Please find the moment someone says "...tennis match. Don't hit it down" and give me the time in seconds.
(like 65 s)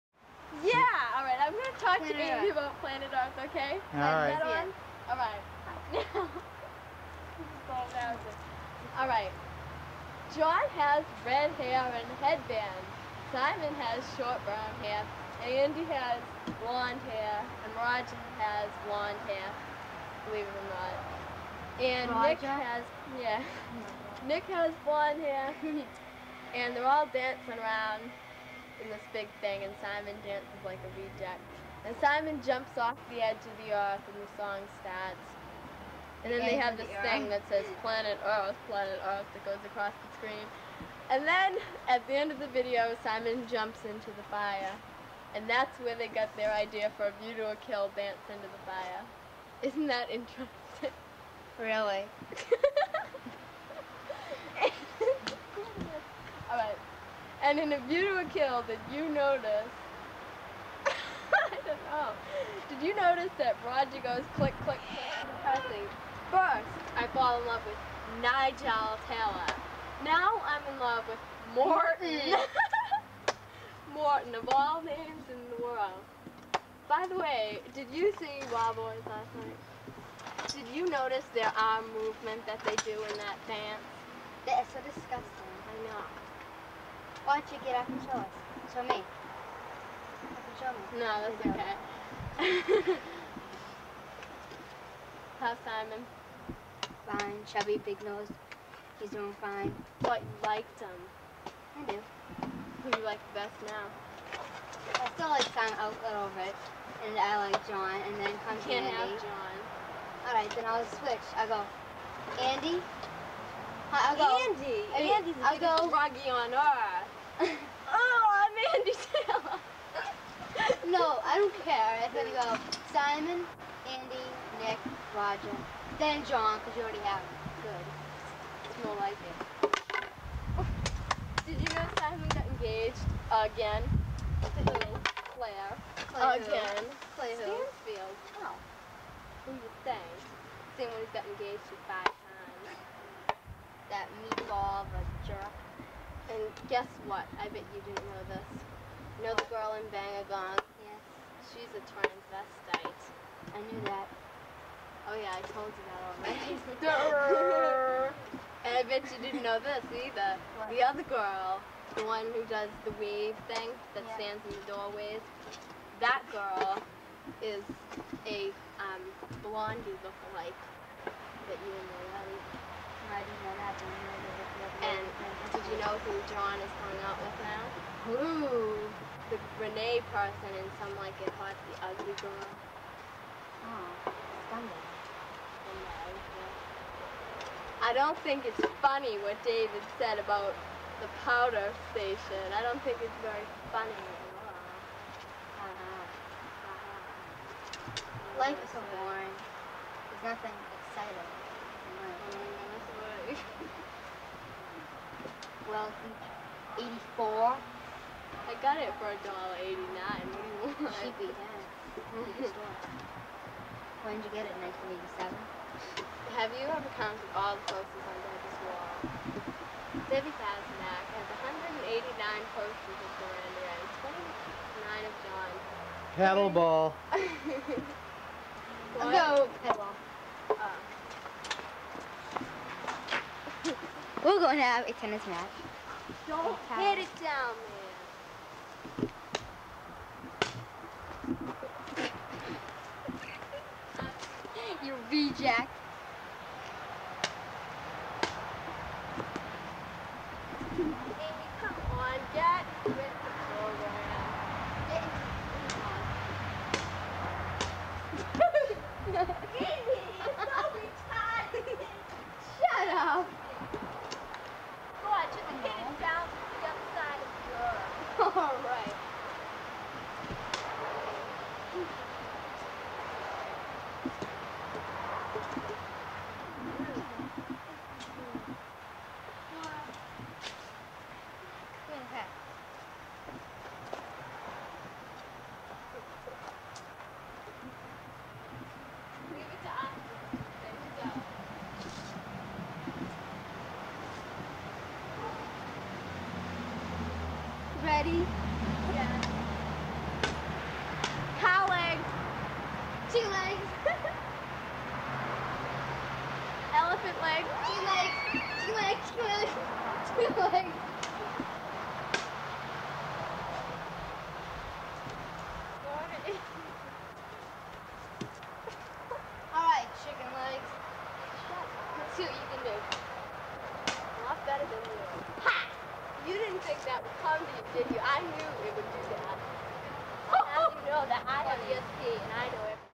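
234 s.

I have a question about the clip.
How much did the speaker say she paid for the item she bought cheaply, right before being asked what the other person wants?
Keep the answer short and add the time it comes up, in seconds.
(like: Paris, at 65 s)
$1.89, at 209 s.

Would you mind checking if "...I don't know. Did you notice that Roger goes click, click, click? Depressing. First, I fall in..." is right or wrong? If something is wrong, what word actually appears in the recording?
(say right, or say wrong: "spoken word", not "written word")
right.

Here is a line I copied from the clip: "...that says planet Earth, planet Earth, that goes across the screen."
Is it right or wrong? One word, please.
right.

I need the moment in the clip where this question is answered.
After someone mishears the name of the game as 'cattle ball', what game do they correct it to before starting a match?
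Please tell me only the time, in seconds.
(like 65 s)
229 s.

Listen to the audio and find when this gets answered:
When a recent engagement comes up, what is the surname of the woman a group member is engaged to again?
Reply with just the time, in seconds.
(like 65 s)
137 s.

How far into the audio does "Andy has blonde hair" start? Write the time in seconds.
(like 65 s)
15 s.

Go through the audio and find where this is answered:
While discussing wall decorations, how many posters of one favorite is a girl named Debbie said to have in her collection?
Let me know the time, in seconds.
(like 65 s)
221 s.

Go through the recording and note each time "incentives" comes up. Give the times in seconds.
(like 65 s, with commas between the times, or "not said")
not said.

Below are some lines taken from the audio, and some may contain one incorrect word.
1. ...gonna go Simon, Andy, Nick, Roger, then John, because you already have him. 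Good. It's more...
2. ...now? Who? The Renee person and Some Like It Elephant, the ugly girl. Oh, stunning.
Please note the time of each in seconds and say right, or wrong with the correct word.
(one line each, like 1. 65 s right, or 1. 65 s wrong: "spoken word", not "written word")
1. 122 s right
2. 177 s wrong: "Hot", not "Elephant".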